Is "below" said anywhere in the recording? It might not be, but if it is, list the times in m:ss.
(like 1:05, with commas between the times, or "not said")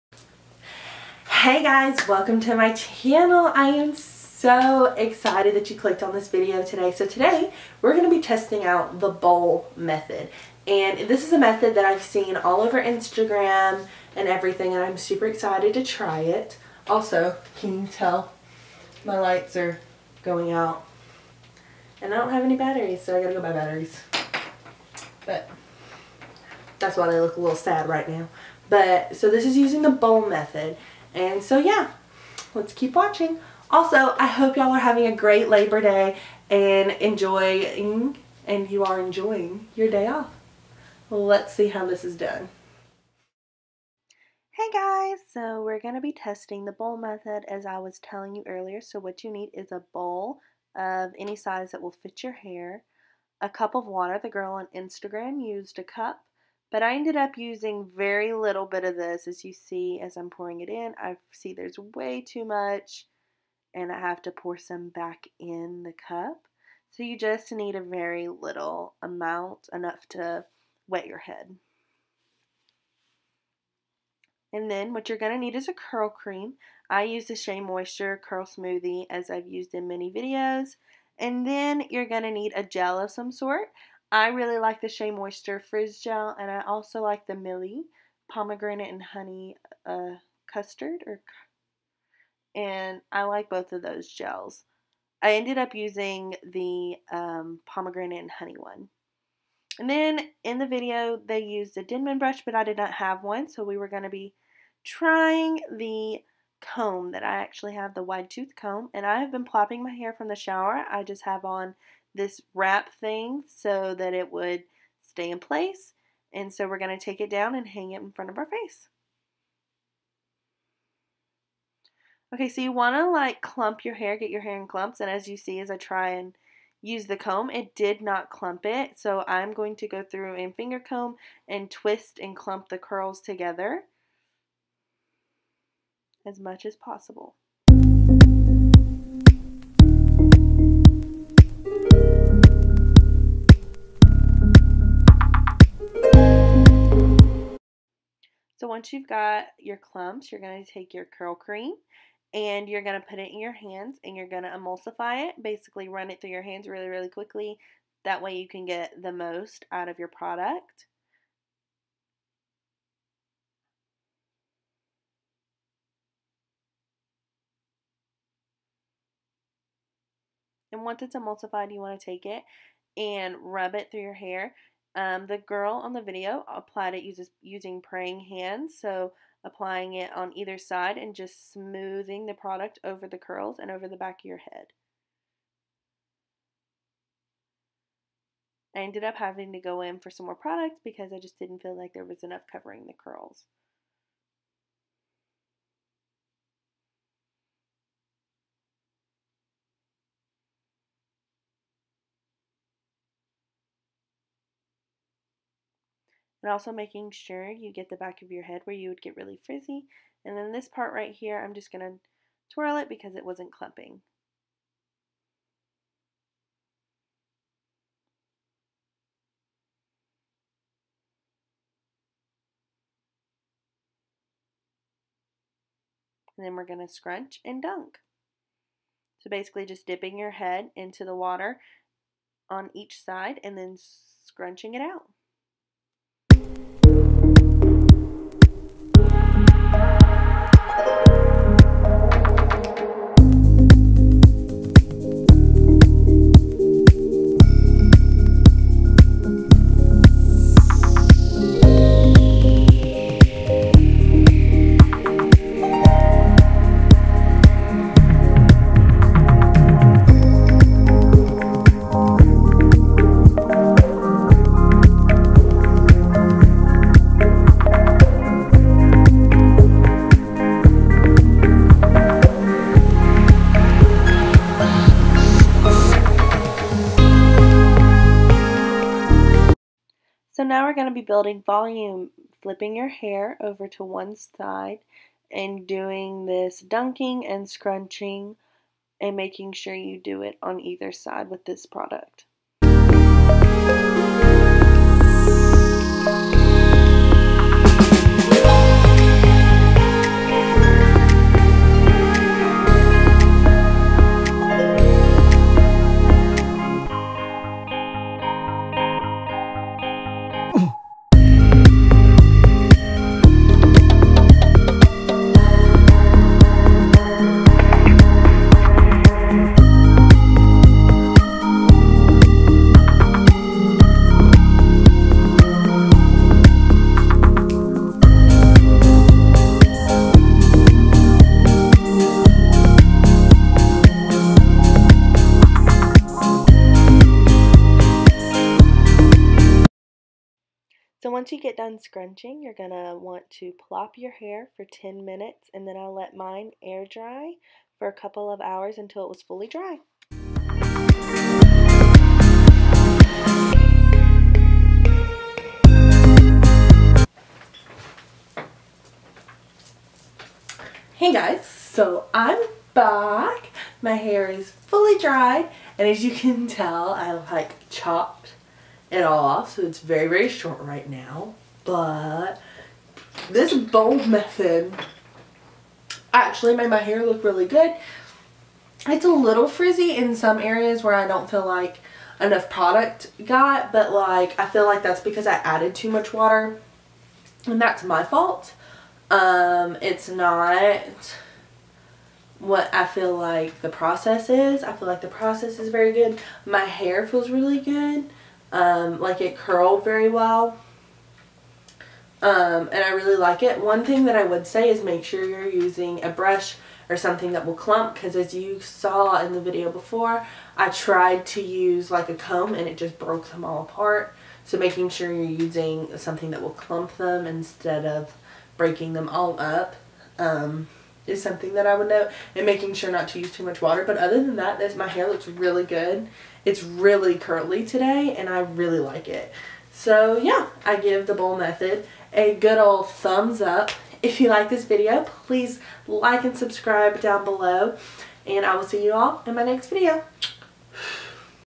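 7:17.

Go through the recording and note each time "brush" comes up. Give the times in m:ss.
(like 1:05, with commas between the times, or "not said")
1:42, 6:46.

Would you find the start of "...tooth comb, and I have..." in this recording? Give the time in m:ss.
1:48.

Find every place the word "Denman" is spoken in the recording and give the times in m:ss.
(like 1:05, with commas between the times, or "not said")
1:41.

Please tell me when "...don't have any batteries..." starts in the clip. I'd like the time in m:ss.
0:22.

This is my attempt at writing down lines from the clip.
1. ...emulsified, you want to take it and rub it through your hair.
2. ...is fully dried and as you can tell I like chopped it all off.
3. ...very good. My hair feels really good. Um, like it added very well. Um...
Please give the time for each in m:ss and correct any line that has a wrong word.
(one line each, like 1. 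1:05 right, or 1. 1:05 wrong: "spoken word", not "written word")
1. 2:51 right
2. 6:04 right
3. 6:35 wrong: "curled", not "added".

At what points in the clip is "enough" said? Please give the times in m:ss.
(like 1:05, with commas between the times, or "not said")
1:09, 3:12, 6:22.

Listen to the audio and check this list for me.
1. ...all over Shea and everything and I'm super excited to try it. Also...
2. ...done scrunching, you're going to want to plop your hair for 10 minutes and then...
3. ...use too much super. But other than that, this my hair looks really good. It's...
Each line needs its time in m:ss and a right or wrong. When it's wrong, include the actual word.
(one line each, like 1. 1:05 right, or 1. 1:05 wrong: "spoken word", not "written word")
1. 0:12 wrong: "Instagram", not "Shea"
2. 5:41 right
3. 7:03 wrong: "water", not "super".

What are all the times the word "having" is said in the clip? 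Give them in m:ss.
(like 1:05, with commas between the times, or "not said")
0:34, 3:09.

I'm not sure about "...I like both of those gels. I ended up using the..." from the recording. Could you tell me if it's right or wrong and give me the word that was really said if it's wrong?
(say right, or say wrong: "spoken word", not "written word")
right.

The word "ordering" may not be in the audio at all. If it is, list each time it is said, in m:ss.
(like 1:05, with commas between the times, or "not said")
not said.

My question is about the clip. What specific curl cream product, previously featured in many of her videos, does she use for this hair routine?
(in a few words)
Shea Moisture Curl Smoothie.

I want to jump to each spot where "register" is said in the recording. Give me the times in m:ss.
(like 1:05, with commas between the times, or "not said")
not said.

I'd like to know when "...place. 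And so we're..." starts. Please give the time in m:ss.
1:55.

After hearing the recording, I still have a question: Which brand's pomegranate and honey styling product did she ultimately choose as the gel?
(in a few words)
Mielle.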